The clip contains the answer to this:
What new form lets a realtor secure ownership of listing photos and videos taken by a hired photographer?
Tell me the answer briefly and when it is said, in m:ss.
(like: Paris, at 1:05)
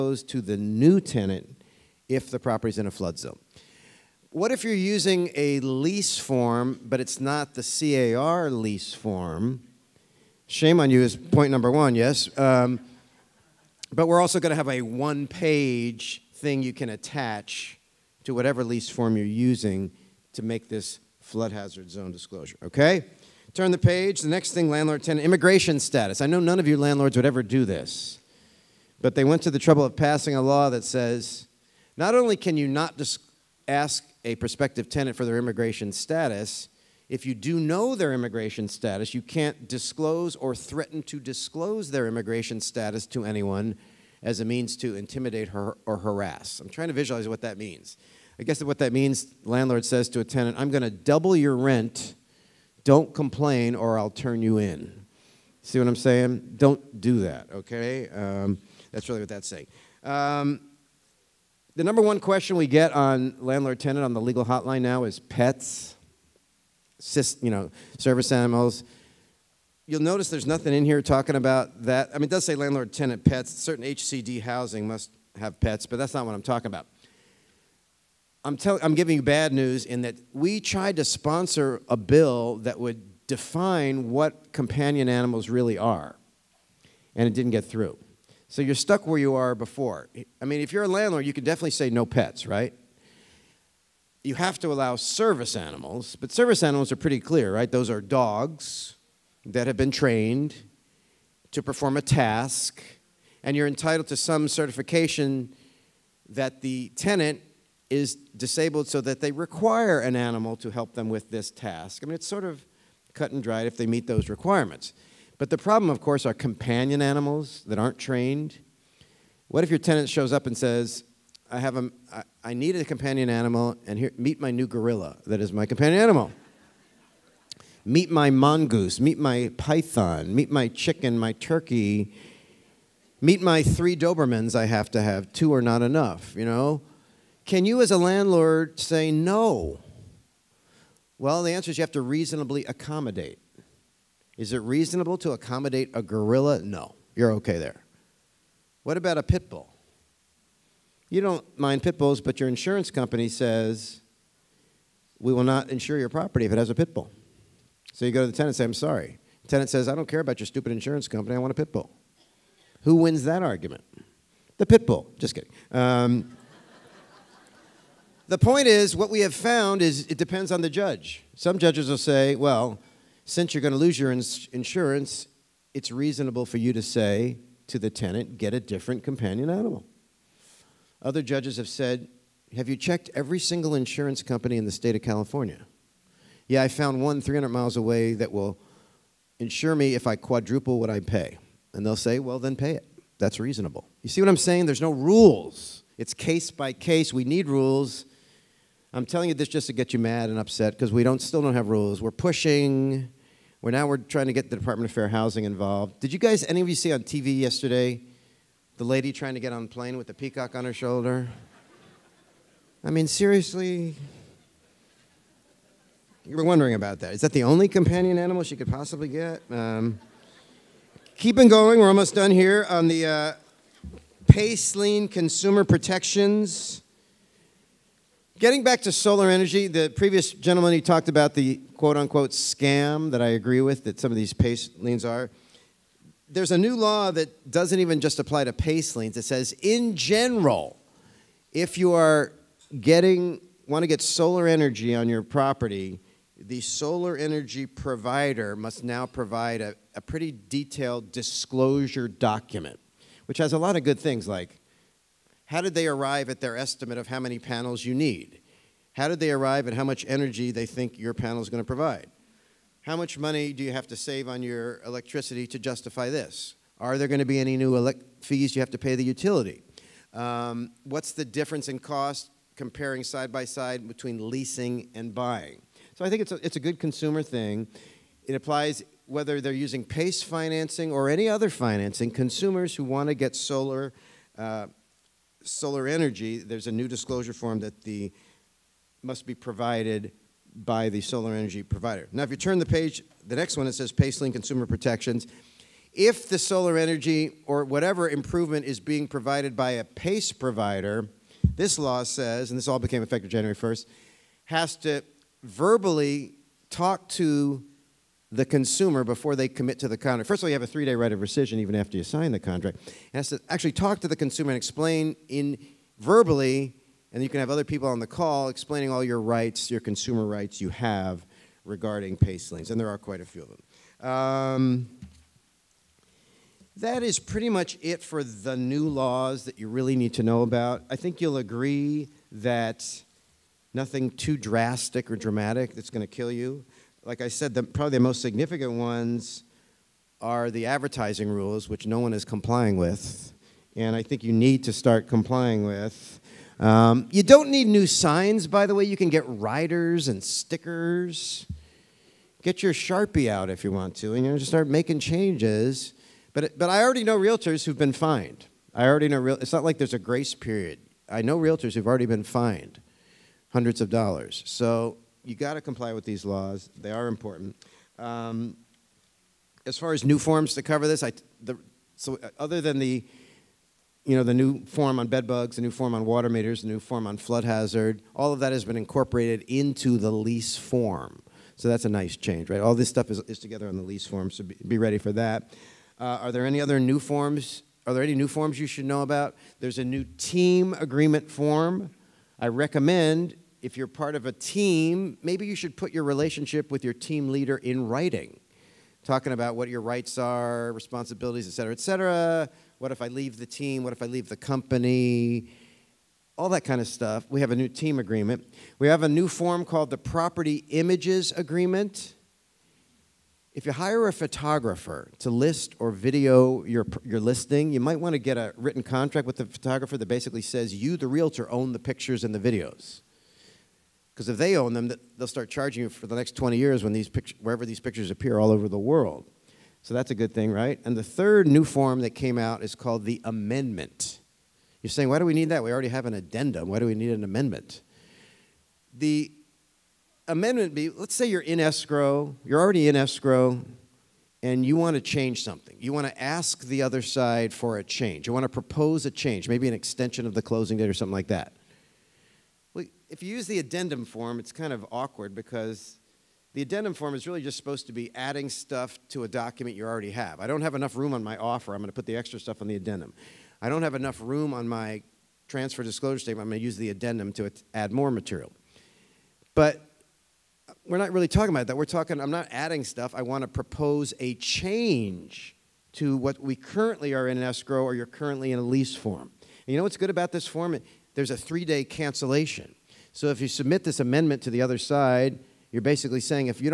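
Property Images Agreement, at 6:49.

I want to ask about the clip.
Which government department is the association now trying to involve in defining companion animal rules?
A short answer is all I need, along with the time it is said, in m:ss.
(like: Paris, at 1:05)
Department of Fair Housing, at 3:24.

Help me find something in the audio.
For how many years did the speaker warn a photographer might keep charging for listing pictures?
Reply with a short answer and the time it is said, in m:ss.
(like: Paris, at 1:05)
20, at 7:06.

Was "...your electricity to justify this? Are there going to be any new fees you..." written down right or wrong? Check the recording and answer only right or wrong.
right.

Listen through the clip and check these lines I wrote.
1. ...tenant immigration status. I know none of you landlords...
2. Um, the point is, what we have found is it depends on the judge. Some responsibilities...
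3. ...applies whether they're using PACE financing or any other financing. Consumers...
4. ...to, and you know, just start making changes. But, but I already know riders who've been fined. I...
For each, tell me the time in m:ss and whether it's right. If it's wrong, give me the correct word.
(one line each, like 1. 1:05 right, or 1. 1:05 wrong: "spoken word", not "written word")
1. 0:25 right
2. 2:45 wrong: "judges", not "responsibilities"
3. 4:38 right
4. 5:53 wrong: "realtors", not "riders".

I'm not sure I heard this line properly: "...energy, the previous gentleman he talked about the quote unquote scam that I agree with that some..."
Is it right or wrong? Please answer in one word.
right.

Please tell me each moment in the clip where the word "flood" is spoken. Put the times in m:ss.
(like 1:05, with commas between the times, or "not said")
0:02, 0:21, 6:17.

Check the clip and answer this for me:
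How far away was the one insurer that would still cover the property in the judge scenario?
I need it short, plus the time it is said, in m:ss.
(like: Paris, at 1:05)
300 miles, at 3:07.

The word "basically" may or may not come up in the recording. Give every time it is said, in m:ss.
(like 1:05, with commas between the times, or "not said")
7:00, 8:05.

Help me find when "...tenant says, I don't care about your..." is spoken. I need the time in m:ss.
2:39.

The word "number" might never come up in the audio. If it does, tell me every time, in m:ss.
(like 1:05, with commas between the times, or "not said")
0:11, 1:01.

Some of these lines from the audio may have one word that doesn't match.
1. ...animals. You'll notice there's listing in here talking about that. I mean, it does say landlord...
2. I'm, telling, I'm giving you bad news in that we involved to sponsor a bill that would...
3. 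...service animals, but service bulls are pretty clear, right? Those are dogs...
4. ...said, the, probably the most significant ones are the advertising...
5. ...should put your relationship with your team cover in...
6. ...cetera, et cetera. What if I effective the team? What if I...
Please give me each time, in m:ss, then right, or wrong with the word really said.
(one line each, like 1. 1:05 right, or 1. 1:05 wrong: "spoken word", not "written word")
1. 1:08 wrong: "nothing", not "listing"
2. 1:18 wrong: "tried", not "involved"
3. 1:34 wrong: "animals", not "bulls"
4. 5:37 right
5. 6:35 wrong: "leader", not "cover"
6. 6:41 wrong: "leave", not "effective".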